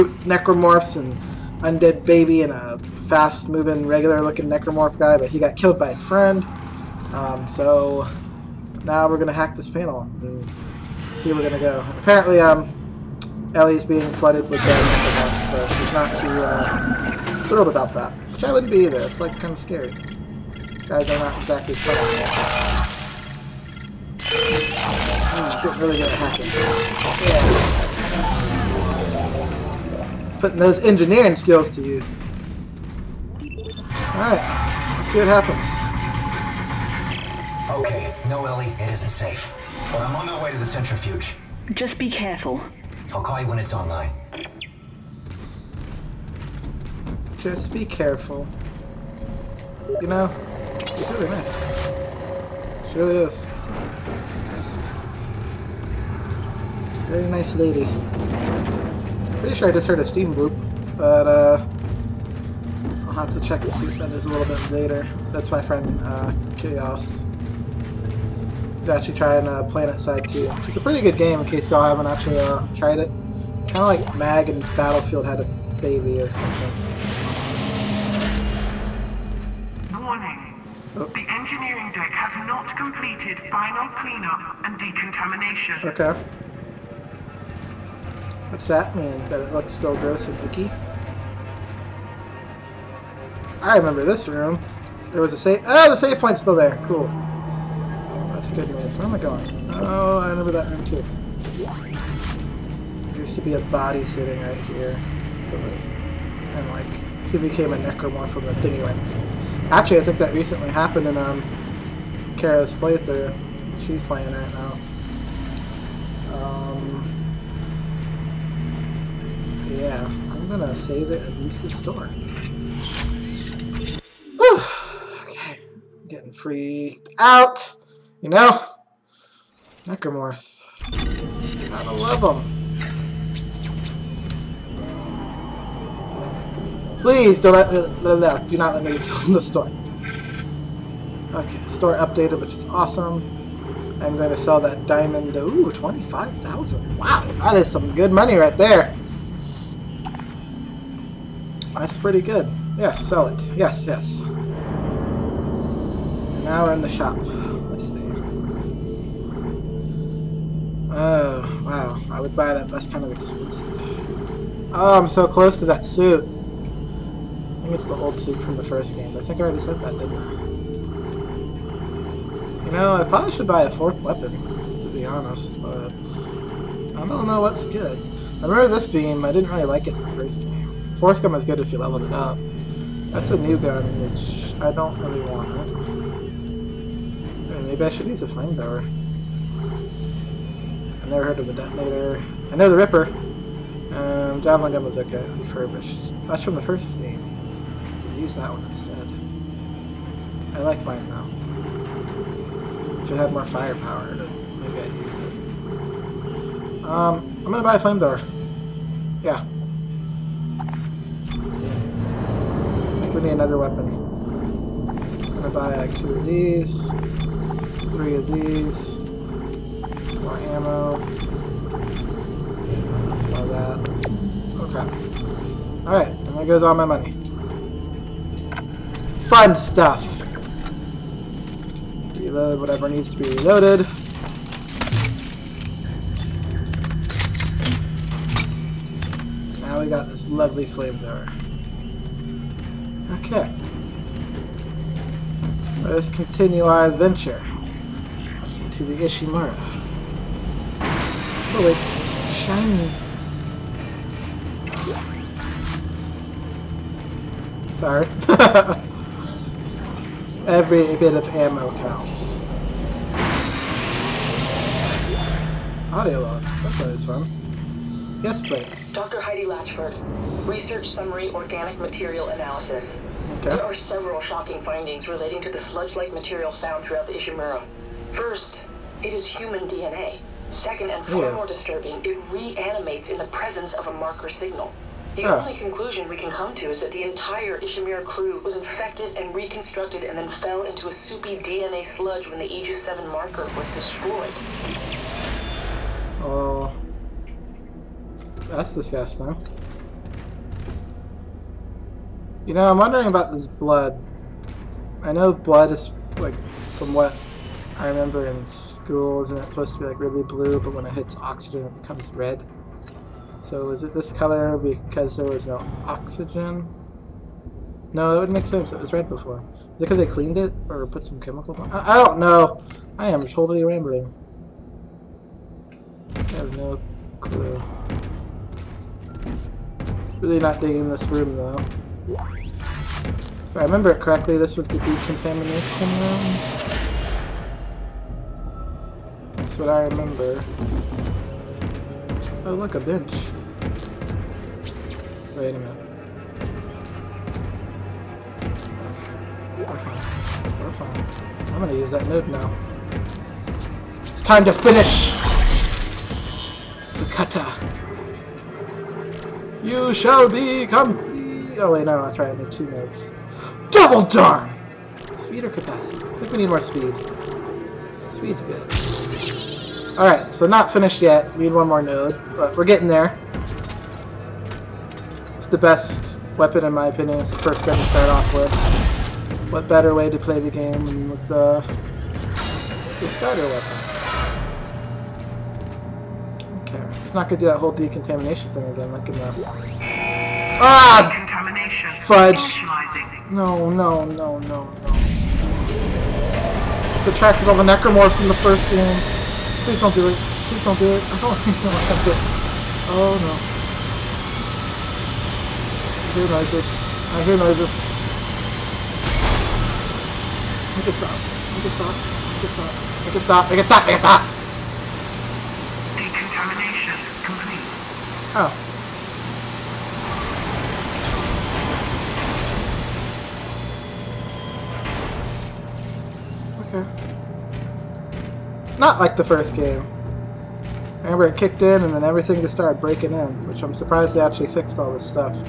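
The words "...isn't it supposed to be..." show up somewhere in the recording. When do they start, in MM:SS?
05:08.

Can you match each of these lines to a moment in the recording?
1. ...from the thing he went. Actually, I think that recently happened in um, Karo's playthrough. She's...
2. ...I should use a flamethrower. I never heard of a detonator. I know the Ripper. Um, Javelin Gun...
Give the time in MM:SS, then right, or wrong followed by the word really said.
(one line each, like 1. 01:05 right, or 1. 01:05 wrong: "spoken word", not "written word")
1. 01:48 right
2. 03:07 right.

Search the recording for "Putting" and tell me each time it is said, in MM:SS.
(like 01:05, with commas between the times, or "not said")
00:30.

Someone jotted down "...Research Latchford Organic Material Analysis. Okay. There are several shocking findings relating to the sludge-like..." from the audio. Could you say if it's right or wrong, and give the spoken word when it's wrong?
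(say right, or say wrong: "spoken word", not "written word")
wrong: "Summary", not "Latchford".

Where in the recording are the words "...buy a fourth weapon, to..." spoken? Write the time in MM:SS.
02:53.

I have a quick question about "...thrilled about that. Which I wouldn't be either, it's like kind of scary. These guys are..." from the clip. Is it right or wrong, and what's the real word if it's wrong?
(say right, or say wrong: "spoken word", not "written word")
right.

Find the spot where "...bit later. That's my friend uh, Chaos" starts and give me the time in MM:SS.
01:04.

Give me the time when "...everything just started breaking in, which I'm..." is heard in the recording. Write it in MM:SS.
07:12.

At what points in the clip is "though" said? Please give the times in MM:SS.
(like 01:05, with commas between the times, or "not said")
03:21, 05:31.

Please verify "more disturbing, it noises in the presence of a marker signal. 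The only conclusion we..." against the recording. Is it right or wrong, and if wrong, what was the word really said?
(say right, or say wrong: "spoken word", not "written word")
wrong: "reanimates", not "noises".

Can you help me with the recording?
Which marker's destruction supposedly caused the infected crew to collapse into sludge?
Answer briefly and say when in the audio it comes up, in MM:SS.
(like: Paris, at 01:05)
Aegis 7 marker, at 04:52.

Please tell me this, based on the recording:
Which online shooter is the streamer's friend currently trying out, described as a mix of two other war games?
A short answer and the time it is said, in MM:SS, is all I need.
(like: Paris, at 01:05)
PlanetSide 2, at 01:09.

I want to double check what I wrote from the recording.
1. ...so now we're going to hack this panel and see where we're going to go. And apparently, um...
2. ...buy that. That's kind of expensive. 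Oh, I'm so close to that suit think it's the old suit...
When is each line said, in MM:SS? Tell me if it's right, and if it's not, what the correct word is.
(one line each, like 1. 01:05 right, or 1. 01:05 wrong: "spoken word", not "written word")
1. 00:07 right
2. 02:42 right.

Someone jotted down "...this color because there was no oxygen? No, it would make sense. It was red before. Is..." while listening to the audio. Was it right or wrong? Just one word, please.
right.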